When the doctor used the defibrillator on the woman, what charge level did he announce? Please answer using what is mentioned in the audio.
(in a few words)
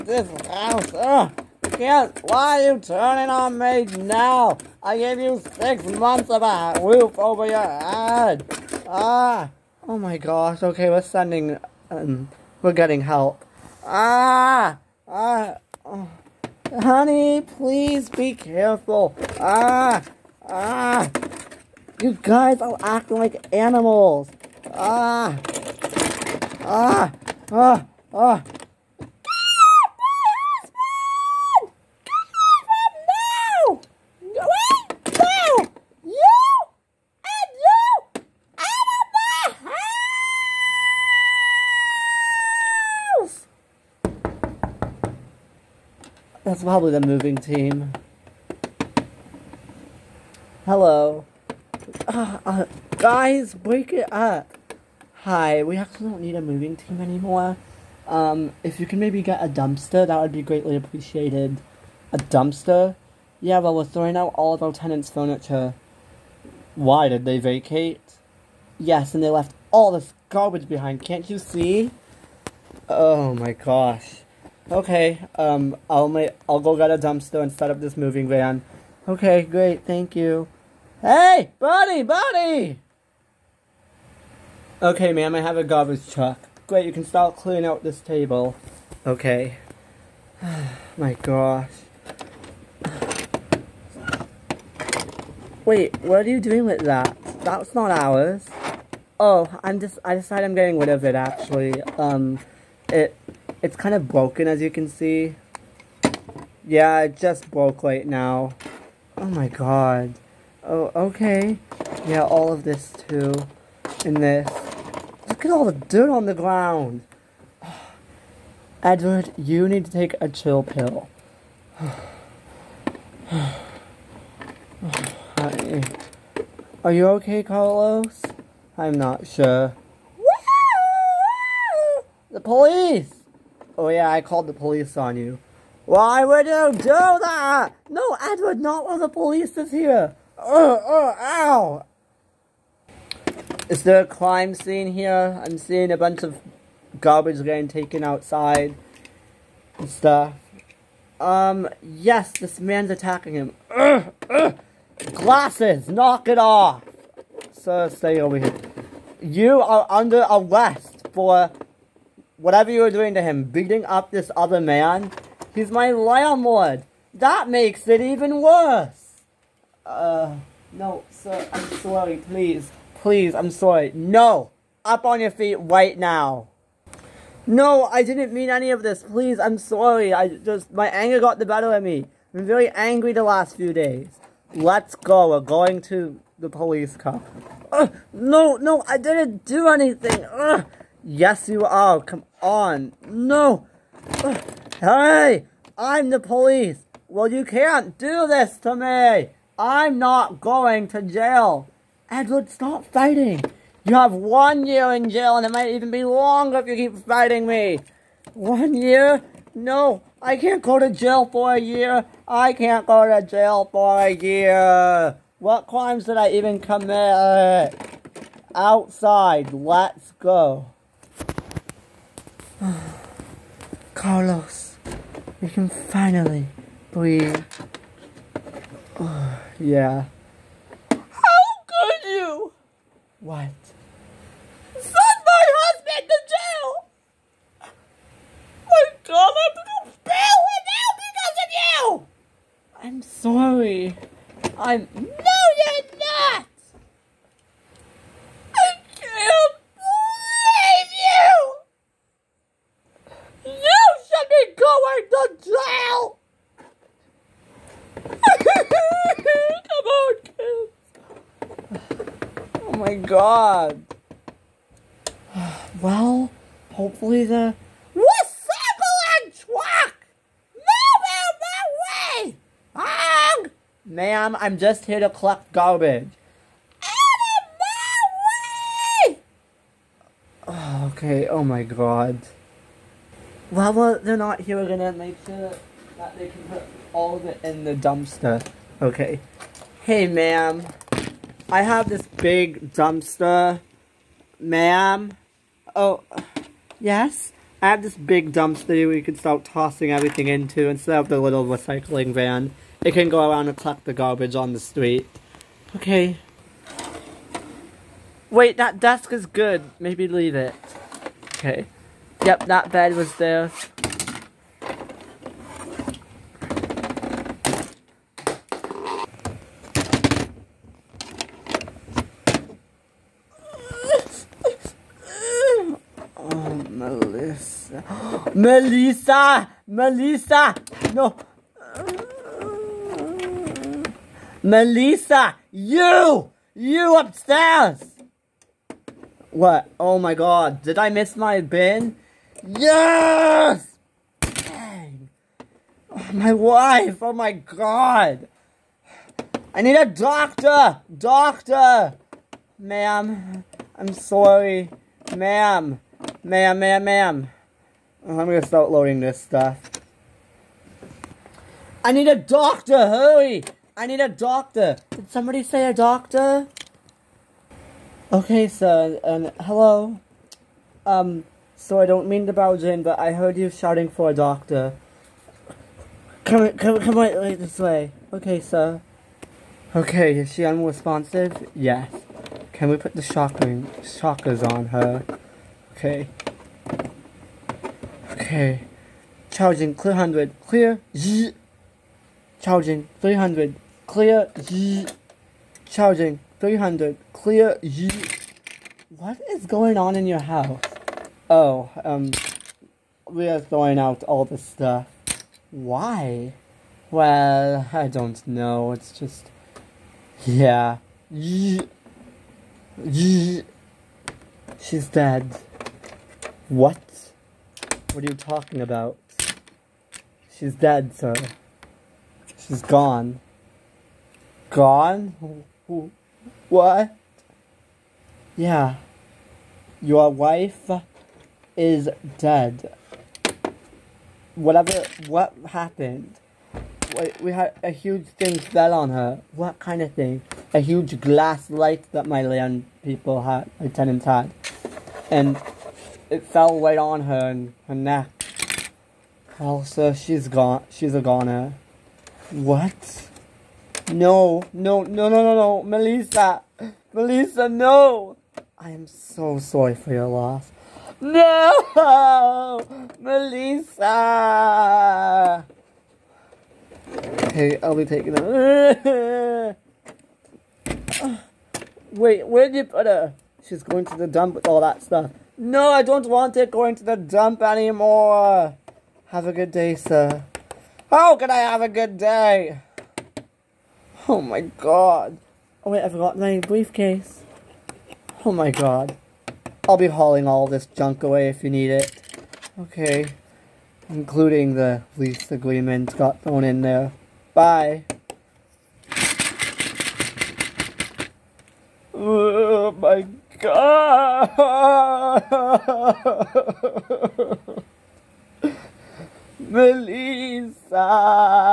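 300.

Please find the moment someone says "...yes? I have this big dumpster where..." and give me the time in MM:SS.
04:56.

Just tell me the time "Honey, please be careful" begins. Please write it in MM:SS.
00:16.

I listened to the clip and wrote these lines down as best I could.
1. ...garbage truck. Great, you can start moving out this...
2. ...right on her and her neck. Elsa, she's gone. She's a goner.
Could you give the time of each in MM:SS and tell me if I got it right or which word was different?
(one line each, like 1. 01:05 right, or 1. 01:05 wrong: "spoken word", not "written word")
1. 01:25 wrong: "clearing", not "moving"
2. 07:26 right.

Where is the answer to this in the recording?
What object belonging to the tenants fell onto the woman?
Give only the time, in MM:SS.
07:20.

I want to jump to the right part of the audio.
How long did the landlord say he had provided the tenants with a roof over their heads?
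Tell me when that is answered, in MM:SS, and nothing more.
00:05.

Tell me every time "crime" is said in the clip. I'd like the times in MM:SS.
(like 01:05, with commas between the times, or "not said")
02:24, 03:35.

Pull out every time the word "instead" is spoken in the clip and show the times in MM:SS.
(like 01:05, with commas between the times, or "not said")
05:00.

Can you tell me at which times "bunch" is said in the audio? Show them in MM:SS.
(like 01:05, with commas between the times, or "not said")
02:25.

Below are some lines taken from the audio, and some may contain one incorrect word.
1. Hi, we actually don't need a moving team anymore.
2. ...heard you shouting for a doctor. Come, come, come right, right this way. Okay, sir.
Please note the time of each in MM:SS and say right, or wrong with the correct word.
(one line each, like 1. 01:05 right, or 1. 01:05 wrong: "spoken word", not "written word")
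1. 00:55 right
2. 06:13 right.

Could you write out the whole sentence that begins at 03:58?
My God, I'm going to bail him out because of you!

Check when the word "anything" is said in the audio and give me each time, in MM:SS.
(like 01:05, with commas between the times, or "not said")
03:09.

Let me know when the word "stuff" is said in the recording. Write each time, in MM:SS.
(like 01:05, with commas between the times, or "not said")
02:29, 05:59, 06:44, 07:54.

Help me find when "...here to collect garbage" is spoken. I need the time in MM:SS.
04:34.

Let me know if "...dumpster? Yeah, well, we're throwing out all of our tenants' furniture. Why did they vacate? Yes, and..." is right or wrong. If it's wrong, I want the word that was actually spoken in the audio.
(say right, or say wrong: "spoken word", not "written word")
right.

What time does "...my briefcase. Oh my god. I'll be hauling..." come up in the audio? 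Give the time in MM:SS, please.
08:06.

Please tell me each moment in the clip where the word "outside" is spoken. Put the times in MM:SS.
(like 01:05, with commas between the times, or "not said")
02:28, 03:38.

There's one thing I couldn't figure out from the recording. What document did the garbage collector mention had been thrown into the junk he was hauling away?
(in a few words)
The lease agreement.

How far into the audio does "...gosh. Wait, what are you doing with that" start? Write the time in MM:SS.
01:31.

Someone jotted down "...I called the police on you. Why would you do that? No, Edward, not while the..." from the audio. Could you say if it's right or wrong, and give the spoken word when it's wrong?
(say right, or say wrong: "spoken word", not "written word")
right.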